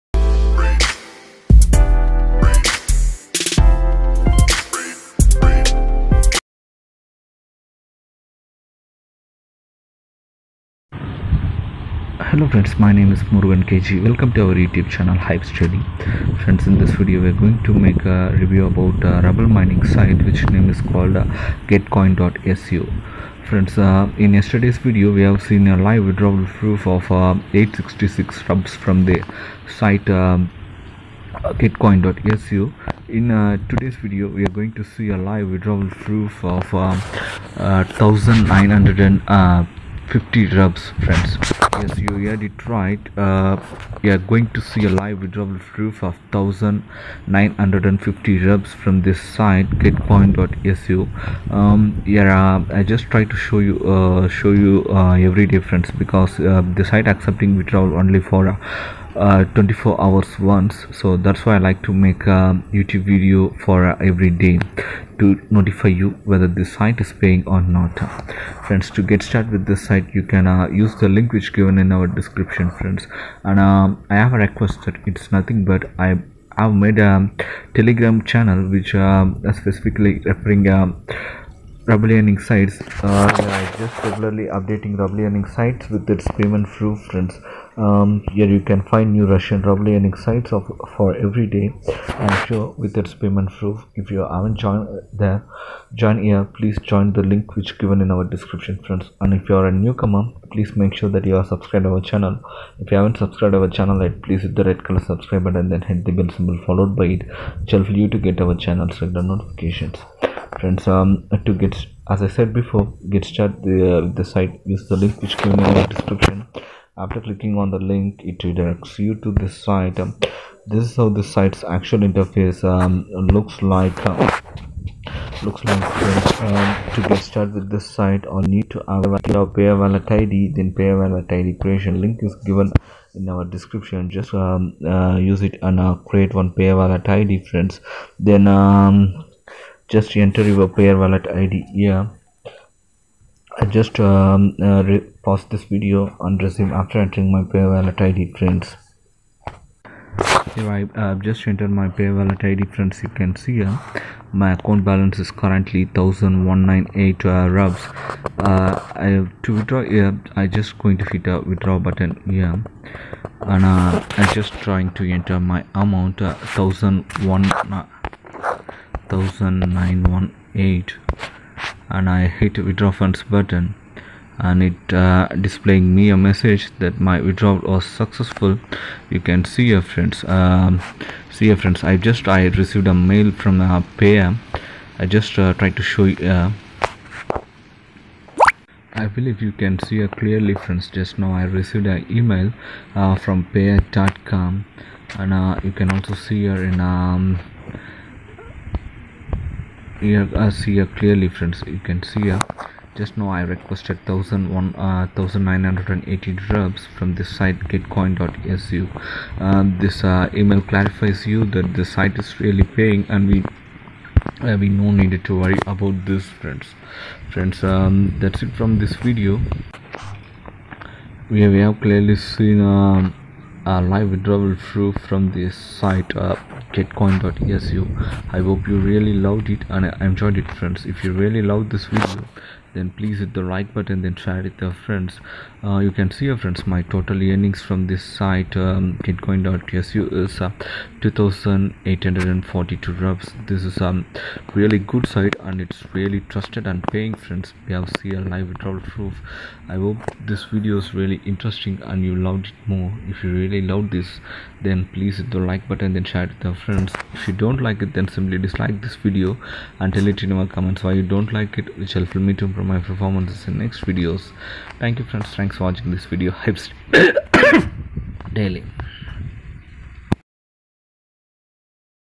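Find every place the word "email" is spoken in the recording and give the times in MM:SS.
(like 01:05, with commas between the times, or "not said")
03:12, 03:30.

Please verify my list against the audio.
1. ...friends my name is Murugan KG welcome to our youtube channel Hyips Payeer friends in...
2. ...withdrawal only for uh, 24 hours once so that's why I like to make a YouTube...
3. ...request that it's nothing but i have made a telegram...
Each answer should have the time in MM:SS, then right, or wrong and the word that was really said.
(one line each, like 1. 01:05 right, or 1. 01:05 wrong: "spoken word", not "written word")
1. 00:12 wrong: "Daily", not "Payeer"
2. 00:57 right
3. 01:14 right.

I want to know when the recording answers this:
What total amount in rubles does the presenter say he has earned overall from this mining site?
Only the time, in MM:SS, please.
04:01.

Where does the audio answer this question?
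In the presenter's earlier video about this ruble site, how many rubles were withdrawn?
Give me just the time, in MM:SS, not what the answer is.
00:27.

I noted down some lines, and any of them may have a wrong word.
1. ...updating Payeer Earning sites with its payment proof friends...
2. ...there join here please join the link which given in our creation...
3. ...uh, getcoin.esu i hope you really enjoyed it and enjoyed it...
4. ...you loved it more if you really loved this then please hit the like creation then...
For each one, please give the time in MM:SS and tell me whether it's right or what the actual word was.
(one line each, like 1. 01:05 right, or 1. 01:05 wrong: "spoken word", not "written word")
1. 01:24 wrong: "Ruble", not "Payeer"
2. 01:35 wrong: "description", not "creation"
3. 03:46 wrong: "loved", not "enjoyed"
4. 04:12 wrong: "button", not "creation".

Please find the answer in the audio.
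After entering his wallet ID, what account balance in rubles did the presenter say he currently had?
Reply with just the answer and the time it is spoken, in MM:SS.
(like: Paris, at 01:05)
1198, at 02:35.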